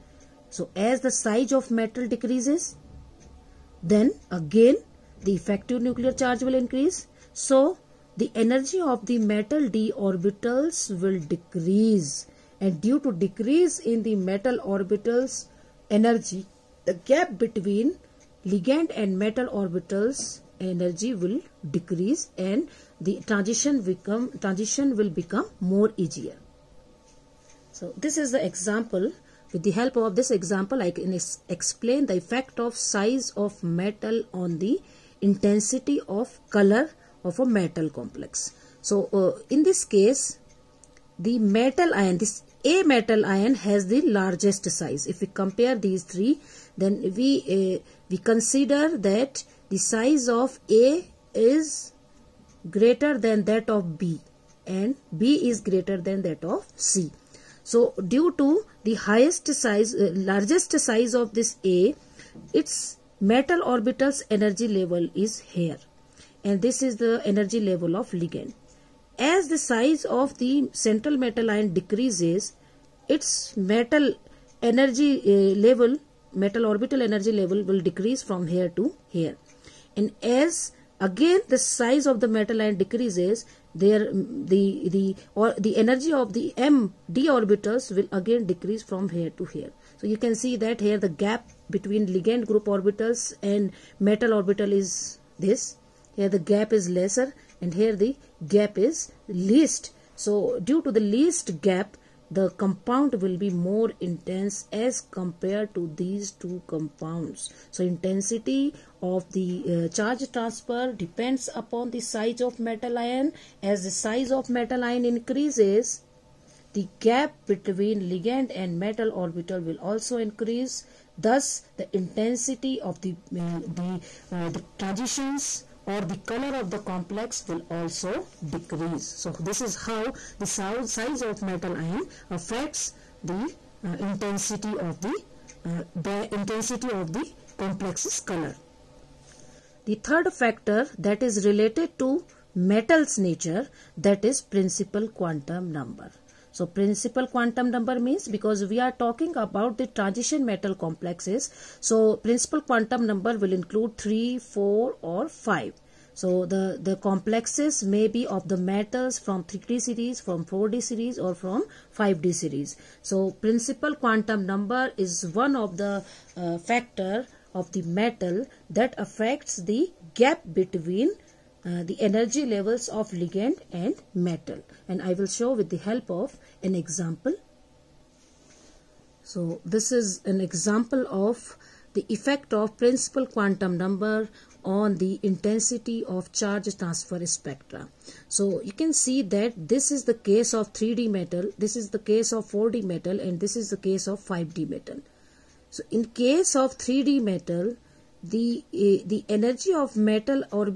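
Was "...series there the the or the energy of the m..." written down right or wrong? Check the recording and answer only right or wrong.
wrong.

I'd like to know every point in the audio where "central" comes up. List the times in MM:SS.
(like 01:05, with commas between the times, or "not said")
01:10.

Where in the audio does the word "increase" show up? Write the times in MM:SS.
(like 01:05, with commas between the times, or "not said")
00:06, 01:55, 02:00.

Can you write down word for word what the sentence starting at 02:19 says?
The third factor that is related to metal's nature that is principal quantum number.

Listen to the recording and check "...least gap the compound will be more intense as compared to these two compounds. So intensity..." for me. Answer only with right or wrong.
right.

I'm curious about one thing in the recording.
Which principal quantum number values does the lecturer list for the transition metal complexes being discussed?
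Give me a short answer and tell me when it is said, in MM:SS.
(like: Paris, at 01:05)
3, 4 or 5, at 02:33.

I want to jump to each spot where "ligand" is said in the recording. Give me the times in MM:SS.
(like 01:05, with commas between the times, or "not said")
00:18, 01:08, 01:32, 01:58, 02:53.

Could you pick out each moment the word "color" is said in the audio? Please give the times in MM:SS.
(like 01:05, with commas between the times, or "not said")
00:36, 02:06, 02:18.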